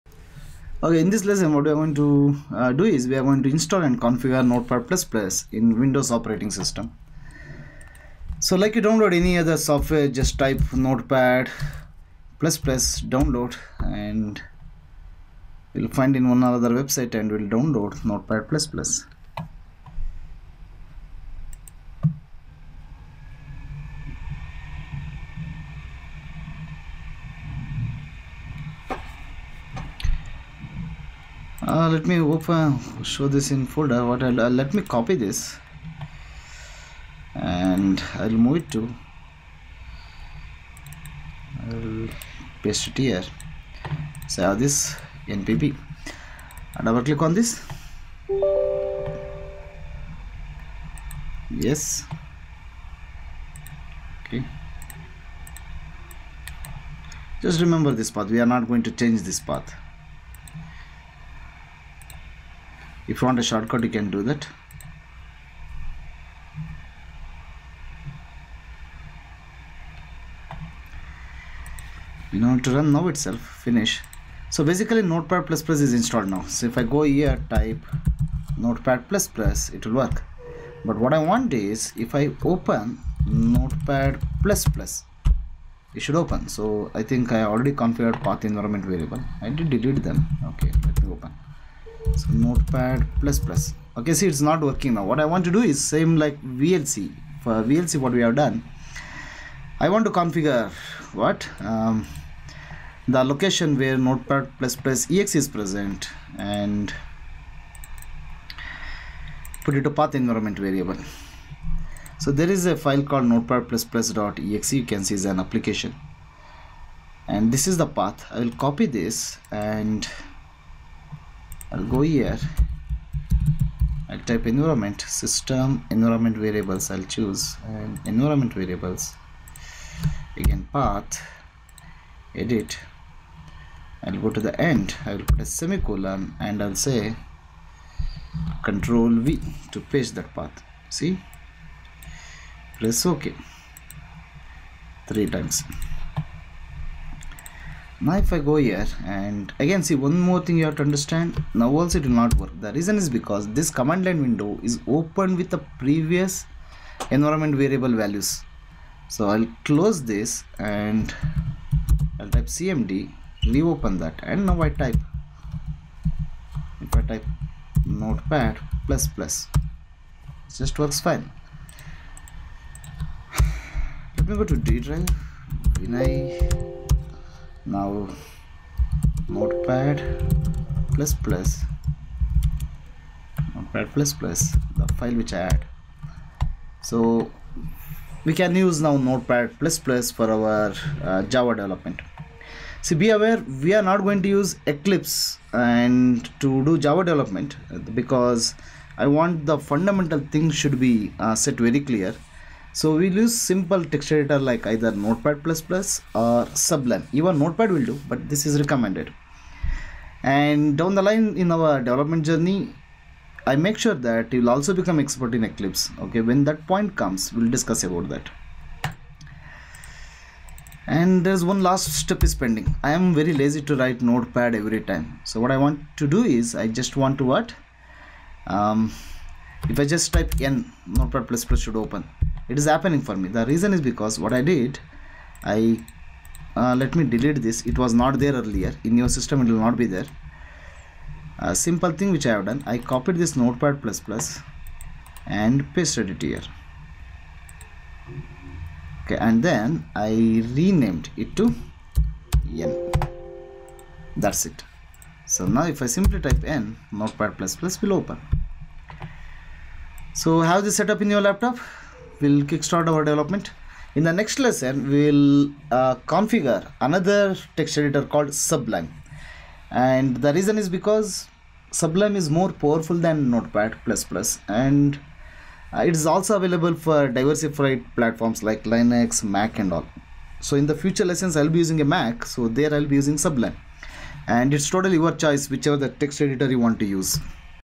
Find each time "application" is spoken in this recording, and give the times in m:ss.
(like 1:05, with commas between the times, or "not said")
1:55.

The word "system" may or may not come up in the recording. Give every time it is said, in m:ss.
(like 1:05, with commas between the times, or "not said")
0:06, 2:05, 3:59.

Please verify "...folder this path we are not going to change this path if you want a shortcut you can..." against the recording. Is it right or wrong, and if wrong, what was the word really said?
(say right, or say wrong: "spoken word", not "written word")
wrong: "remember", not "folder".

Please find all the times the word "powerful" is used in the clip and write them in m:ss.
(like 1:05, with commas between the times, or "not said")
4:32.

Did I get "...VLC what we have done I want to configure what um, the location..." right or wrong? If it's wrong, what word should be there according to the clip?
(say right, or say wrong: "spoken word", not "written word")
right.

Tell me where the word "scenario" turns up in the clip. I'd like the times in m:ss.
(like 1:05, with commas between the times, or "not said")
not said.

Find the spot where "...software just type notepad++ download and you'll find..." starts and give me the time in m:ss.
0:09.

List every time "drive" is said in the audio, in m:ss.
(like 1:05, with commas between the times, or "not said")
2:54.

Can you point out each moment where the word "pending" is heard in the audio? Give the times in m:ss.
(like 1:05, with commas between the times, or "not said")
3:42.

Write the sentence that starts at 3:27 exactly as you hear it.
Even Notepad will do, but this is recommended.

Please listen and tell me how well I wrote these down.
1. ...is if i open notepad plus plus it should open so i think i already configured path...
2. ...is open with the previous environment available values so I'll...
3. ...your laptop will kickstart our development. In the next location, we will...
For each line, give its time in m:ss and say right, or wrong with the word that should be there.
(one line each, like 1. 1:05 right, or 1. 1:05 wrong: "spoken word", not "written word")
1. 1:21 right
2. 2:34 wrong: "variable", not "available"
3. 4:21 wrong: "lesson", not "location".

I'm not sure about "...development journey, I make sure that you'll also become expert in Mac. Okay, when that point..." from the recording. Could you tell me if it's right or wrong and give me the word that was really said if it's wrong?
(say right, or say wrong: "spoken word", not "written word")
wrong: "Eclipse", not "Mac".